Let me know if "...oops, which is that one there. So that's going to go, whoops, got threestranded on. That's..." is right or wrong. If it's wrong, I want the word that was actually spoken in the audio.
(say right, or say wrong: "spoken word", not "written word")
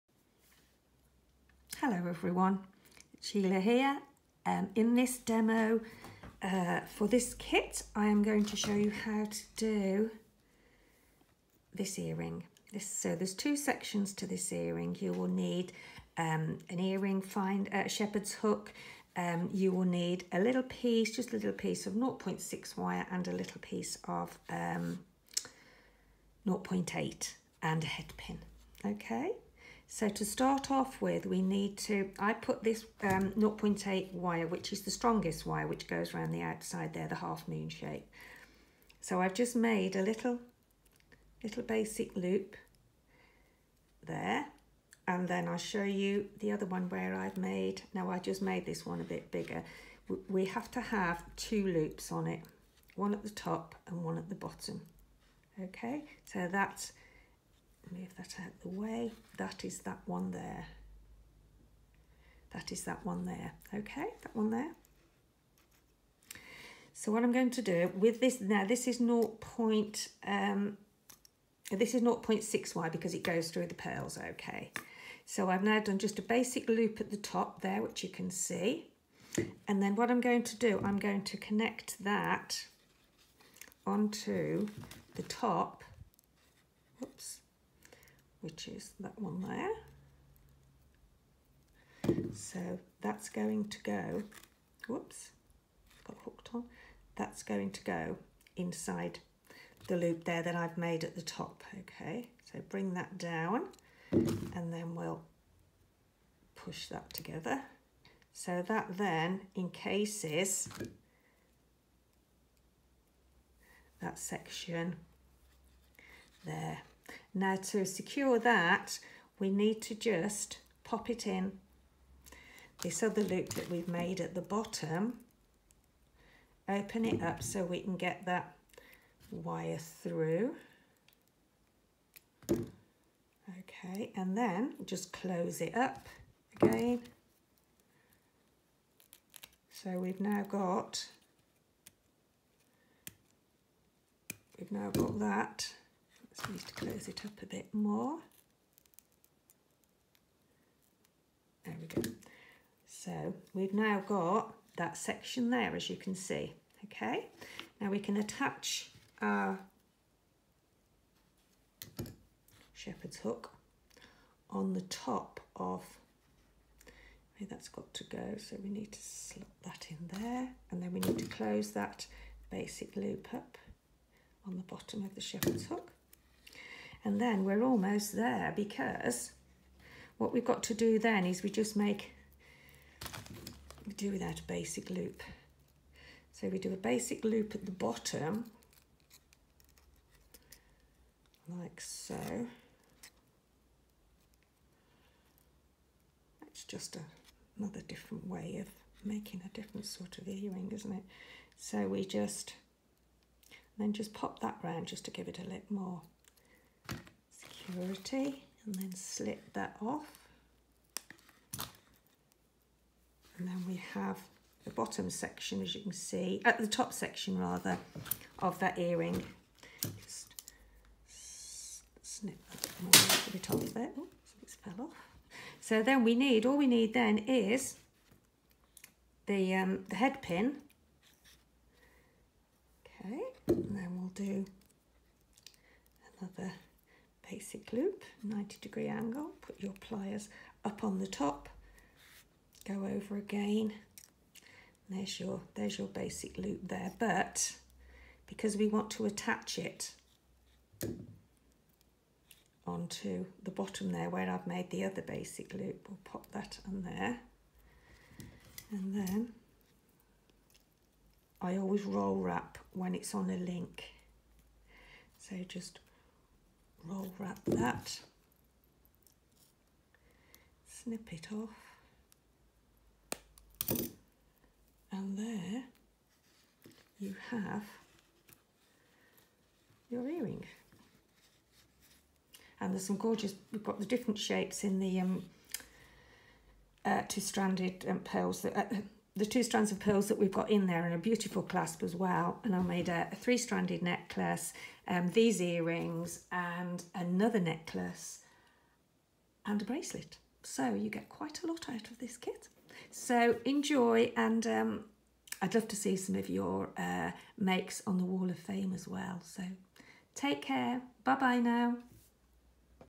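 wrong: "hooked", not "threestranded".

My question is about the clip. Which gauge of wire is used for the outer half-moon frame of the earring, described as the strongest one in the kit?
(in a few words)
0.8.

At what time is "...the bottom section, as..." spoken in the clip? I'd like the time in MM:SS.
03:34.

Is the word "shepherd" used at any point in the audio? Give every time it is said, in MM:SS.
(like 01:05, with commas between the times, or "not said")
00:17, 02:42, 02:55.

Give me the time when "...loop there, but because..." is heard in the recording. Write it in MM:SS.
04:06.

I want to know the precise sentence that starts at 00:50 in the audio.
We have to have two loops on it, one at the top and one at the bottom.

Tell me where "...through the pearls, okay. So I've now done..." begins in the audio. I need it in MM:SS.
01:13.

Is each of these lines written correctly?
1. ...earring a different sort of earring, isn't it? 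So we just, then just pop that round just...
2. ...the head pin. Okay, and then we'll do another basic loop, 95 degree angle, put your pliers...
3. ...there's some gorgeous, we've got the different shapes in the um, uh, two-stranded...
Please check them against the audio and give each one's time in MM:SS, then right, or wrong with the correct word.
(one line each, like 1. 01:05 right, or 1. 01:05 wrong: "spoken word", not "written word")
1. 03:19 wrong: "making", not "earring"
2. 03:49 wrong: "90", not "95"
3. 04:42 right.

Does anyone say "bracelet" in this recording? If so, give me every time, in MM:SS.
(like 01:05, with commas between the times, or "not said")
04:59.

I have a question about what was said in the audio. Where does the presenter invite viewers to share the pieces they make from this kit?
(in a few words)
Wall of Fame.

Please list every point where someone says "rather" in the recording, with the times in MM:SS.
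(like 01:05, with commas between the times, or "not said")
03:37.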